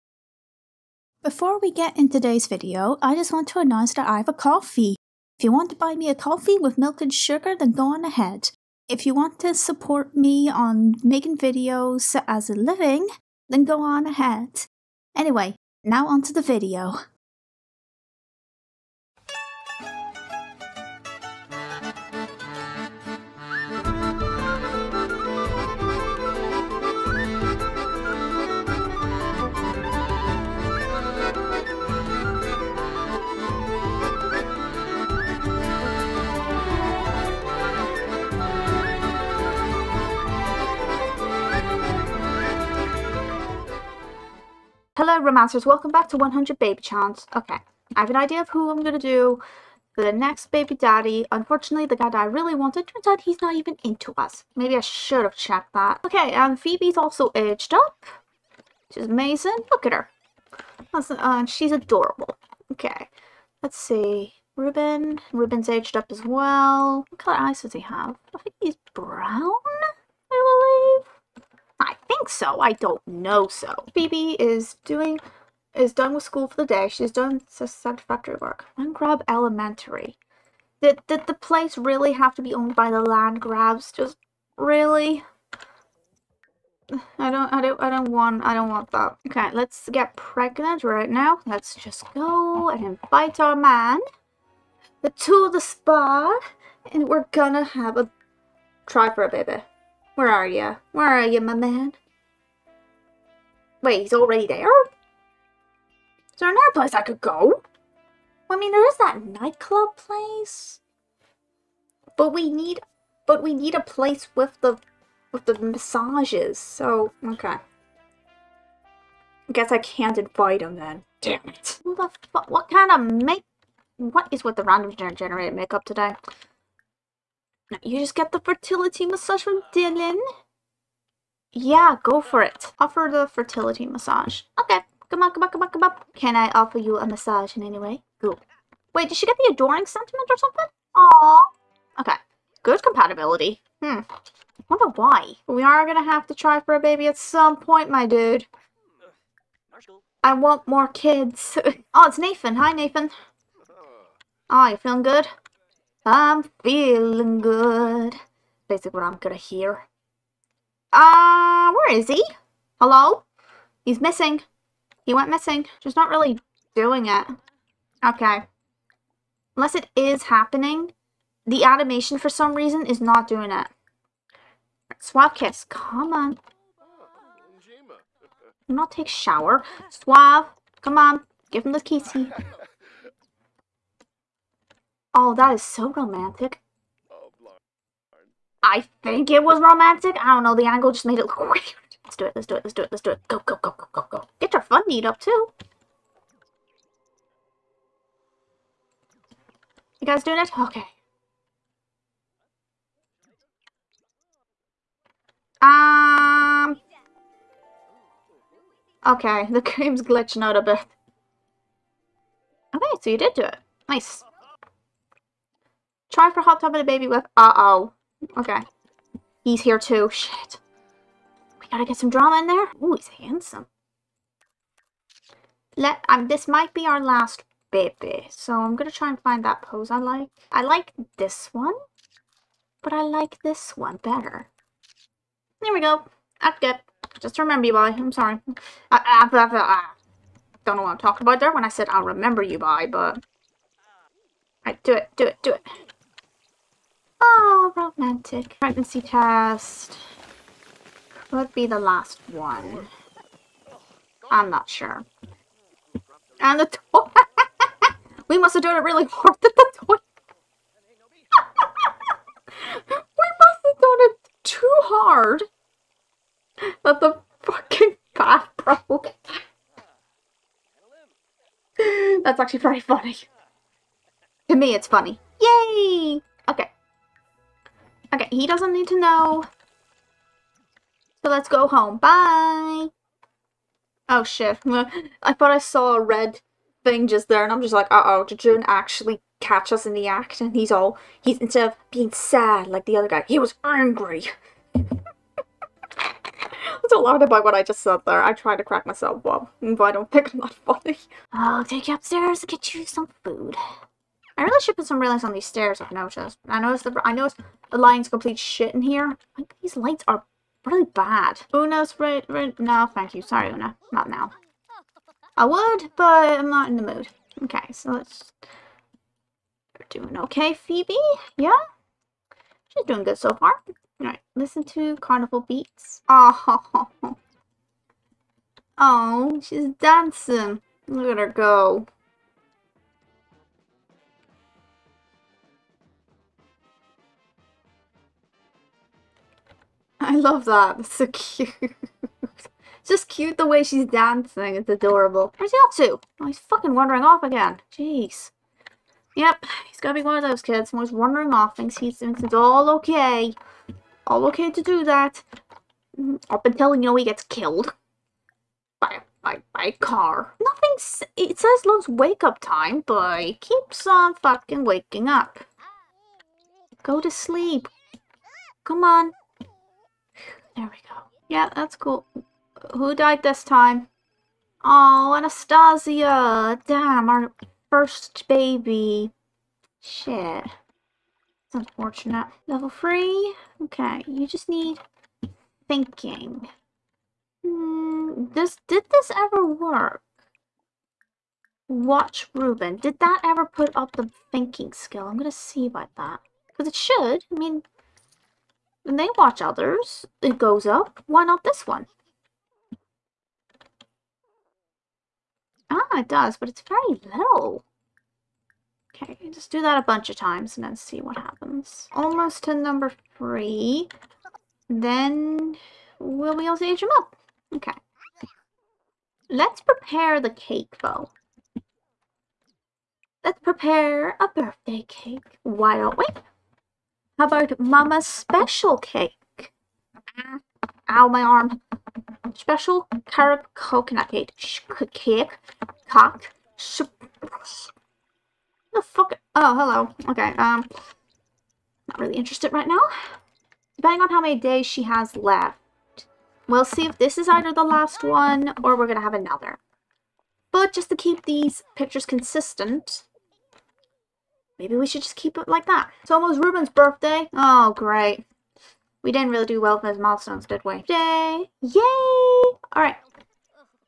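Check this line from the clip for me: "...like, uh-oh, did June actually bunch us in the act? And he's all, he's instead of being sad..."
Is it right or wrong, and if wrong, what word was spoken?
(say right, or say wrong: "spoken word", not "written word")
wrong: "catch", not "bunch".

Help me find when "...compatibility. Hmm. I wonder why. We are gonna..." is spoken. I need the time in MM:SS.
02:22.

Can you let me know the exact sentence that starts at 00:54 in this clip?
Maybe I should have checked that.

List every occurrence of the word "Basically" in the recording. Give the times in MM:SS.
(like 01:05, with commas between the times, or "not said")
02:38.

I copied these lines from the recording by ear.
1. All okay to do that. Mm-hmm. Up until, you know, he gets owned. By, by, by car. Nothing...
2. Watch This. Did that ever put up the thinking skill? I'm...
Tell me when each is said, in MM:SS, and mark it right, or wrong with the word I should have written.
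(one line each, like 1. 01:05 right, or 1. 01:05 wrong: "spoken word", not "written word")
1. 05:54 wrong: "killed", not "owned"
2. 06:31 wrong: "Ruben", not "This".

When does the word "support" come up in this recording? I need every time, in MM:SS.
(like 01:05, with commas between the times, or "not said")
00:09.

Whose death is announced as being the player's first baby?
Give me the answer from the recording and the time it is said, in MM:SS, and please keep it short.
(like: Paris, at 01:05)
Anastasia, at 06:15.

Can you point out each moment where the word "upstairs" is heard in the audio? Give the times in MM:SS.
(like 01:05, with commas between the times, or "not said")
05:01.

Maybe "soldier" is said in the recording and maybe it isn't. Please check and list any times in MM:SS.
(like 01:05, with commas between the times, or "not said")
not said.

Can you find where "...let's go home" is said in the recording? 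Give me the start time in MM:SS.
04:41.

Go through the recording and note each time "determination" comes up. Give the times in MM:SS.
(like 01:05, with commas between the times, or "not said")
not said.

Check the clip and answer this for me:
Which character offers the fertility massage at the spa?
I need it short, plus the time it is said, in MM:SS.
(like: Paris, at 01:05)
Dylan, at 02:09.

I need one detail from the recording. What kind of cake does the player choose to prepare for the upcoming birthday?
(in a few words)
Special carob coconut cake.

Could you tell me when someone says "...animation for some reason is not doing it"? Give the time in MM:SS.
02:51.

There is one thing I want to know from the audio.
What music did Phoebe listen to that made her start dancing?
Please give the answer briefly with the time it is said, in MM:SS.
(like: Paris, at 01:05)
carnival beats, at 05:24.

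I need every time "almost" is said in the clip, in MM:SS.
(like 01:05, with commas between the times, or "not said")
06:51, 07:36.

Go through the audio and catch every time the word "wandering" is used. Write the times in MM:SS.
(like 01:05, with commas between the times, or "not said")
05:46, 05:50.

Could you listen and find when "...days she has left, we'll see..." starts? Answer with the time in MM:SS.
07:24.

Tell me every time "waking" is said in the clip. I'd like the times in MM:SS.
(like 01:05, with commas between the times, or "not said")
06:04.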